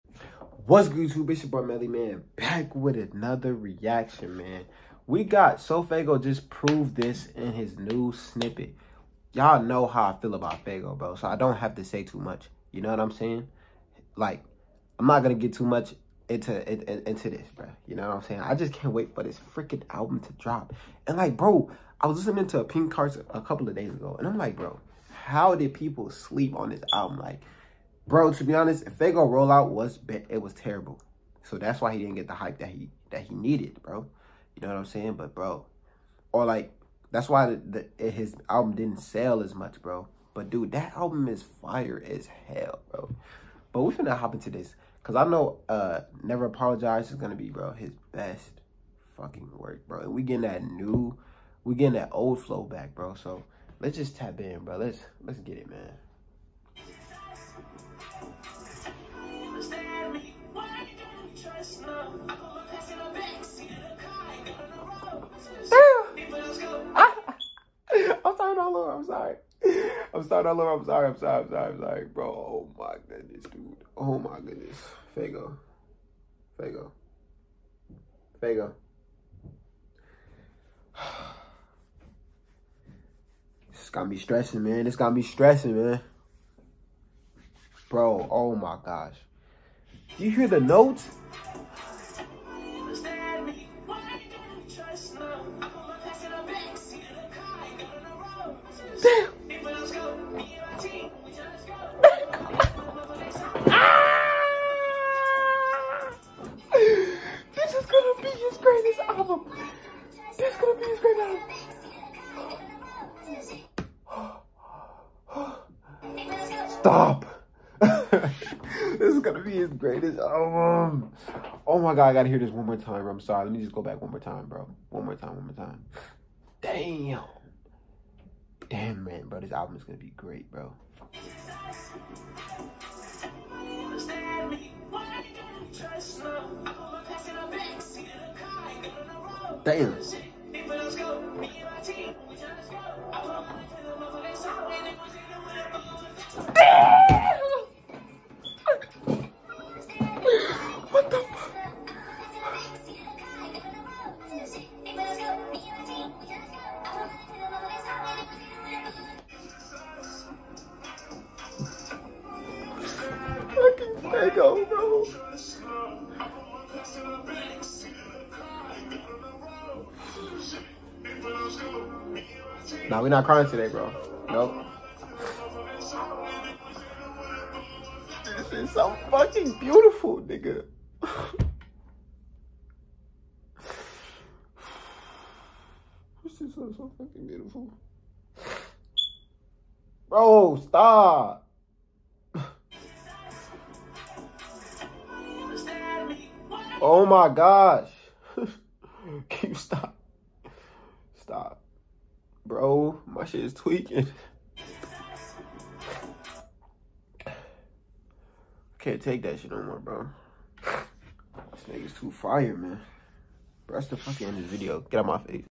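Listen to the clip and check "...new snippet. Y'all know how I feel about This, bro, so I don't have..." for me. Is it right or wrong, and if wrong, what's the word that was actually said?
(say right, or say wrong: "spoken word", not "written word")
wrong: "Faygo", not "This".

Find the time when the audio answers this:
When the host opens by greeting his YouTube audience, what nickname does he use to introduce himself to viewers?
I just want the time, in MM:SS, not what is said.
00:01.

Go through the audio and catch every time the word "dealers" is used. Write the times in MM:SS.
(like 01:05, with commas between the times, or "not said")
not said.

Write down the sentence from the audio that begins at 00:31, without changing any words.
So that's why he didn't get the hype that he that he needed, bro.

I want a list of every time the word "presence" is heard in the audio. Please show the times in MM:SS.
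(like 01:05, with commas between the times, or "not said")
not said.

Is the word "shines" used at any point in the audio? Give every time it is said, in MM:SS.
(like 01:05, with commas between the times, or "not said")
not said.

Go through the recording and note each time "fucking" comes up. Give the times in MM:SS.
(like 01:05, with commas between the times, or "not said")
00:49, 02:59, 03:06, 03:33.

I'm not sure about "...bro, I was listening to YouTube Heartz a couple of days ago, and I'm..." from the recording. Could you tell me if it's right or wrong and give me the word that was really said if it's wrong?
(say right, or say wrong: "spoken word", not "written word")
wrong: "Pink", not "YouTube".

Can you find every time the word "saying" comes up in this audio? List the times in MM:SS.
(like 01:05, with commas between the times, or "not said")
00:13, 00:18, 00:34.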